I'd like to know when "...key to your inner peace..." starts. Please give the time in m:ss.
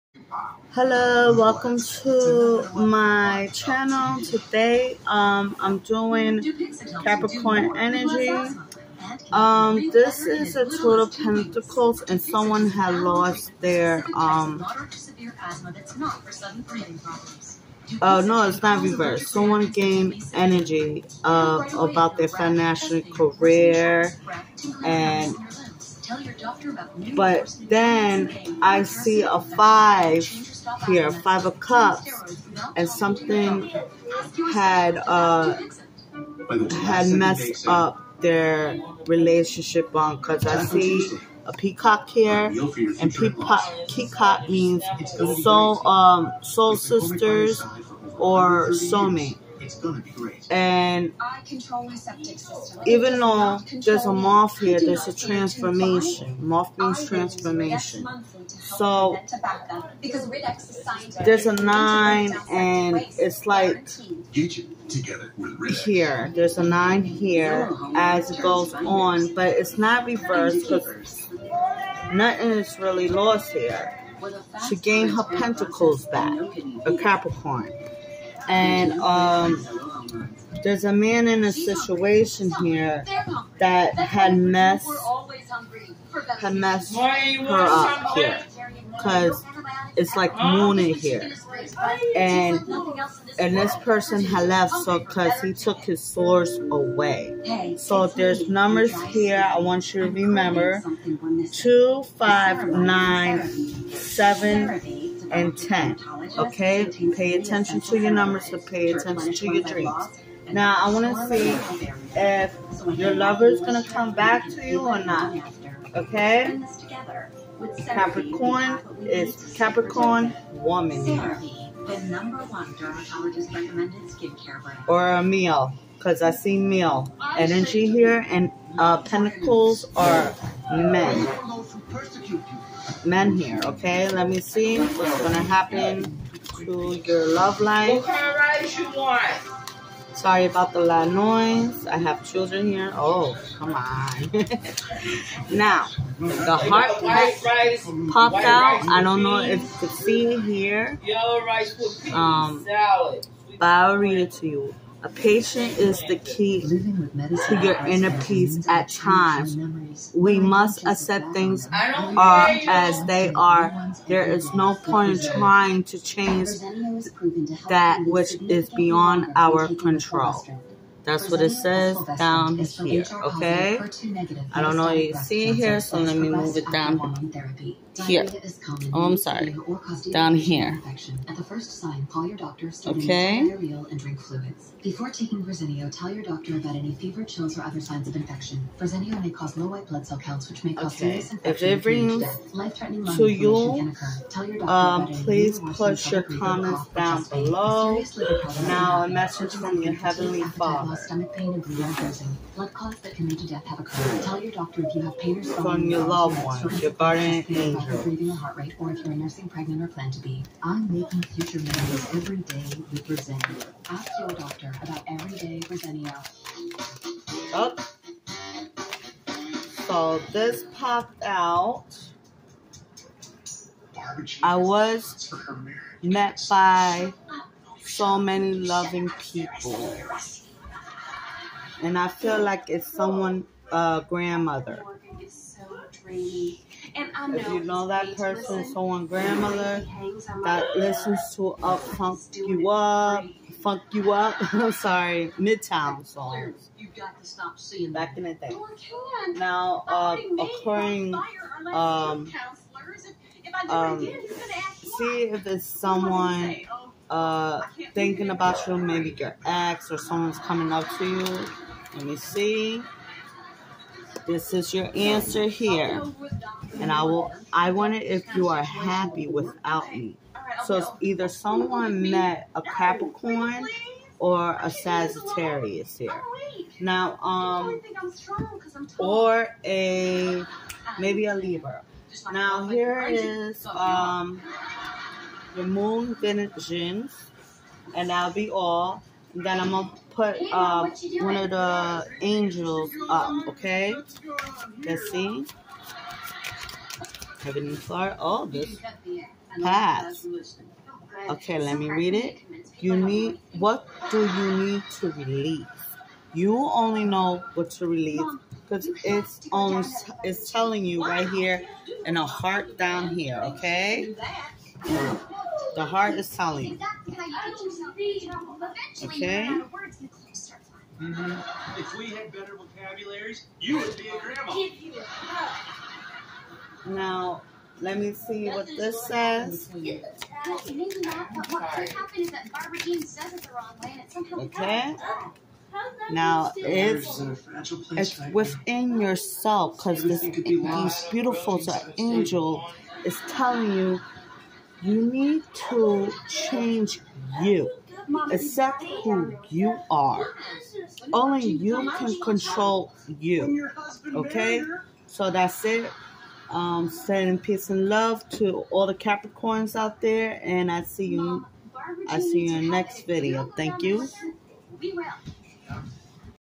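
2:36.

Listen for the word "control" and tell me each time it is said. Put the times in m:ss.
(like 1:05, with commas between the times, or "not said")
2:49, 5:52.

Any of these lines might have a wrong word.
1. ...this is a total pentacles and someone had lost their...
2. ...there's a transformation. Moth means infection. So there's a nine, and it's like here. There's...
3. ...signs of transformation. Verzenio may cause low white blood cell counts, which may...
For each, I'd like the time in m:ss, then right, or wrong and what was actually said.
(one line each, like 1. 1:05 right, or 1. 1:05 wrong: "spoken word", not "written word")
1. 0:09 right
2. 0:54 wrong: "transformation", not "infection"
3. 3:07 wrong: "infection", not "transformation".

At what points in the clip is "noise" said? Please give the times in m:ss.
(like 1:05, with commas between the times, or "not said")
2:21.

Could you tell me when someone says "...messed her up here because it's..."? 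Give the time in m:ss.
1:26.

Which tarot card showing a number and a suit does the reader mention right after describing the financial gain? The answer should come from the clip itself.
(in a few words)
Five of Cups.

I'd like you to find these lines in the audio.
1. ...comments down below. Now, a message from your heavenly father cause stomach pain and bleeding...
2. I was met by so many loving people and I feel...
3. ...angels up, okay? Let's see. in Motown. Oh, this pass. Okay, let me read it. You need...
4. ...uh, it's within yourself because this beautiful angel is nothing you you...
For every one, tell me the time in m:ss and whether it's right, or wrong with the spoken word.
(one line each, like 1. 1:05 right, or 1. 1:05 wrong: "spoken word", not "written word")
1. 3:16 right
2. 3:44 right
3. 4:52 wrong: "Flower", not "Motown"
4. 5:37 wrong: "telling", not "nothing".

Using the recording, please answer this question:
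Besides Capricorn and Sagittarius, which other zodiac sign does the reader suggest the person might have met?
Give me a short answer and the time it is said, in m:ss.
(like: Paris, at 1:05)
Libra, at 4:41.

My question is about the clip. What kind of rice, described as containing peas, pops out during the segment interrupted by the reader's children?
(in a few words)
yellow rice.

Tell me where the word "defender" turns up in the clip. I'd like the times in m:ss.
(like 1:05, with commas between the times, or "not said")
not said.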